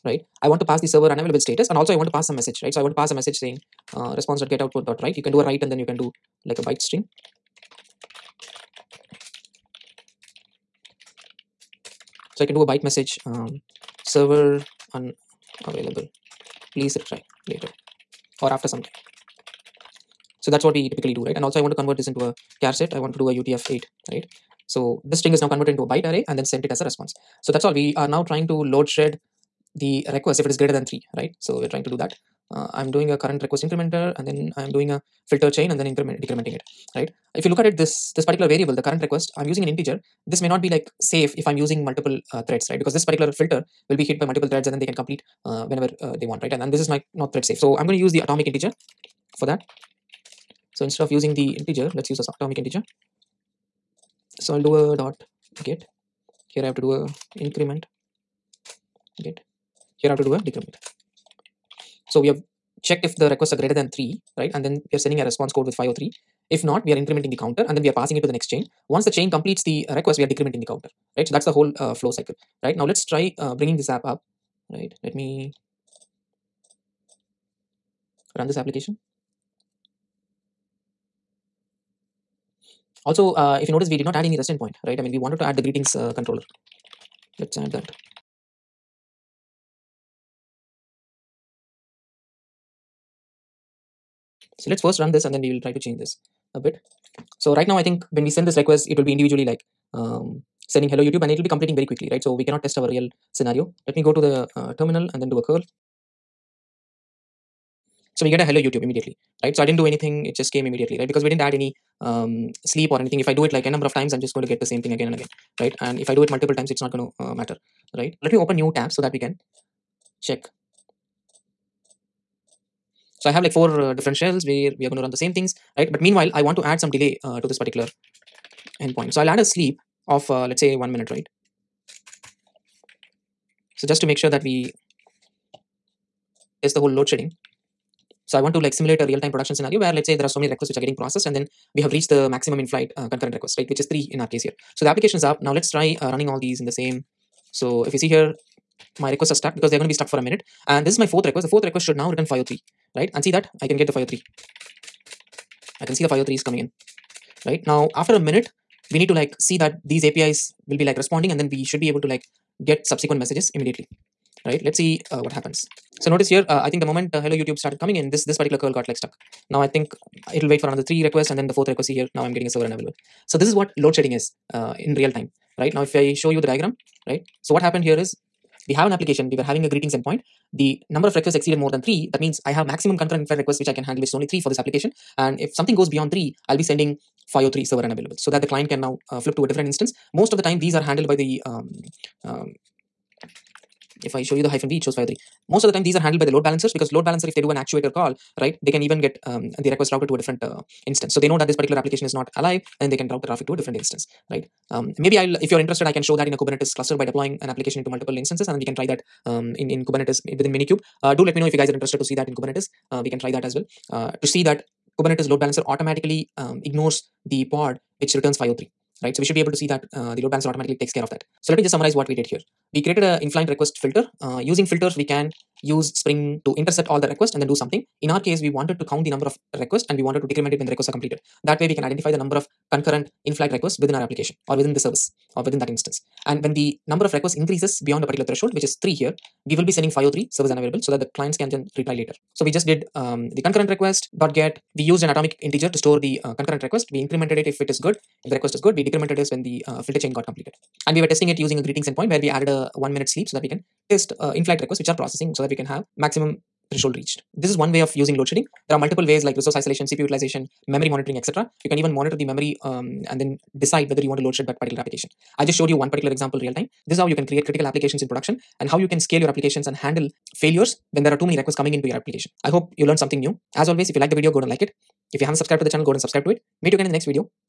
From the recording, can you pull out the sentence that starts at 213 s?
Uh, to see that Kubernetes load balancer automatically um, ignores the pod which returns 503, right?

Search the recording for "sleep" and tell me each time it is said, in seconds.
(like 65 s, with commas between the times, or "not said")
112 s, 129 s, 253 s.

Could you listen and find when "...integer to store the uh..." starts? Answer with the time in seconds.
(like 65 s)
245 s.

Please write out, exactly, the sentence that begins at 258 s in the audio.
There are multiple ways like resource isolation, CPU utilization, memory monitoring, etc.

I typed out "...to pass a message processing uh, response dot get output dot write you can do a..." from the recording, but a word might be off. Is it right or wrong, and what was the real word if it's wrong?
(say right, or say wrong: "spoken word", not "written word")
wrong: "saying", not "processing".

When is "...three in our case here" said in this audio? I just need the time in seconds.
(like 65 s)
143 s.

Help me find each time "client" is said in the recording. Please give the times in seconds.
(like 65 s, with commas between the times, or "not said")
188 s, 241 s.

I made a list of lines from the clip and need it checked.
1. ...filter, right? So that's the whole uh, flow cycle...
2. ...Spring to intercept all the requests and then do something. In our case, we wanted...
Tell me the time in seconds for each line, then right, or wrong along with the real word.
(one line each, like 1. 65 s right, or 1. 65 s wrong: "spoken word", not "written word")
1. 70 s wrong: "counter", not "filter"
2. 225 s right.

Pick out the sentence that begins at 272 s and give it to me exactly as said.
I hope you learned something new.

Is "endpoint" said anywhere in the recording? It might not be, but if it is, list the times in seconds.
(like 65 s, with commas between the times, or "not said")
84 s, 128 s, 179 s, 251 s.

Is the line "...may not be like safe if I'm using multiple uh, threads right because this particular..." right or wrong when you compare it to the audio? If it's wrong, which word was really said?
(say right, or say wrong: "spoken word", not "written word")
right.